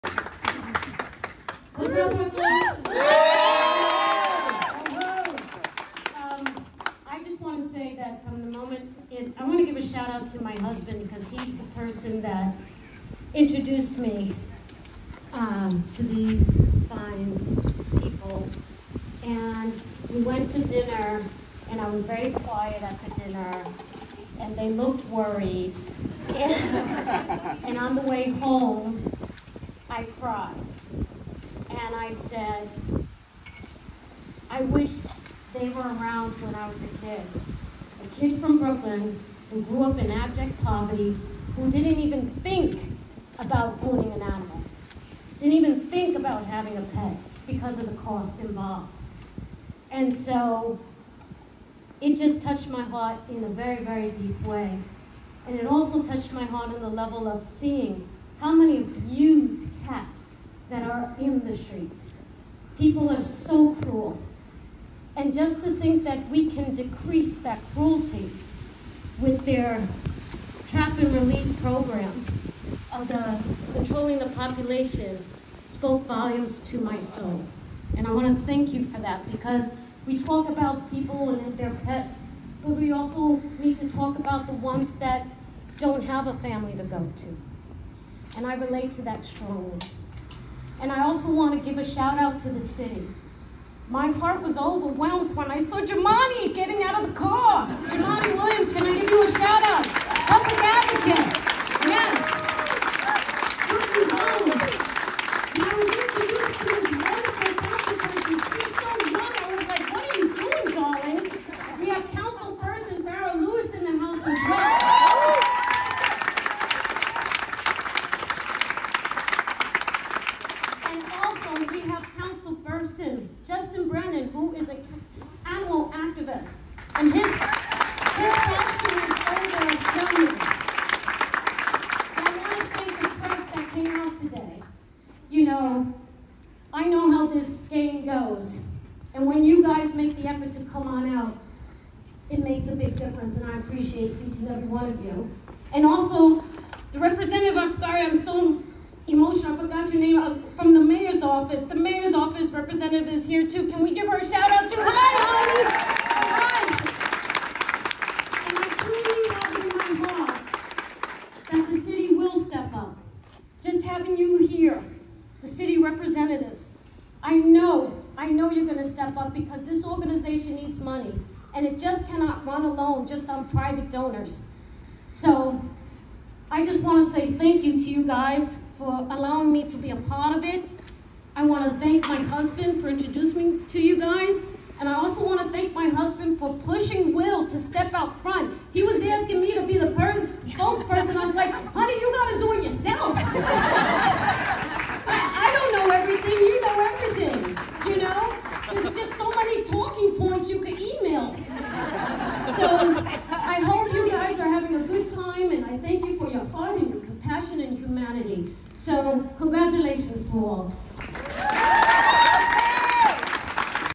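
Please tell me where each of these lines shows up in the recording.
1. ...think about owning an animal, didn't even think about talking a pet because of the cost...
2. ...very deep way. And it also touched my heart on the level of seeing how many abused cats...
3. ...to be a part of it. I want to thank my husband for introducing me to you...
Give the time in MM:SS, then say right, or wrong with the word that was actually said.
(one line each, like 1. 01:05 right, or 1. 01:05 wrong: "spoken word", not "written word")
1. 00:42 wrong: "having", not "talking"
2. 00:53 right
3. 02:59 right.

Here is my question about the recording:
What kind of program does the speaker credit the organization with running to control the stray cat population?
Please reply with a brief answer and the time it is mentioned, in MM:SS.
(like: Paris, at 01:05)
Trap and release, at 01:10.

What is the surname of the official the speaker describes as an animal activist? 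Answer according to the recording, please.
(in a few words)
Brannan.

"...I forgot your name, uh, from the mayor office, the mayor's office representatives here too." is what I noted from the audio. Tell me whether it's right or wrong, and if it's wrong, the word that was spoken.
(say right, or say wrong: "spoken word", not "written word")
right.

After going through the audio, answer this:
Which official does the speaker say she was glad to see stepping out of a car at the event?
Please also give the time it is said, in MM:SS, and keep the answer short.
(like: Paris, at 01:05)
Jumaane Williams, at 01:37.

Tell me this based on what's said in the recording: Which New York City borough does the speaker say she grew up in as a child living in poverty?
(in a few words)
Brooklyn.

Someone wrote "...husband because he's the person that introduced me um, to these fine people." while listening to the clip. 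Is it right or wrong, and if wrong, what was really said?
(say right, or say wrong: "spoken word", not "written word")
right.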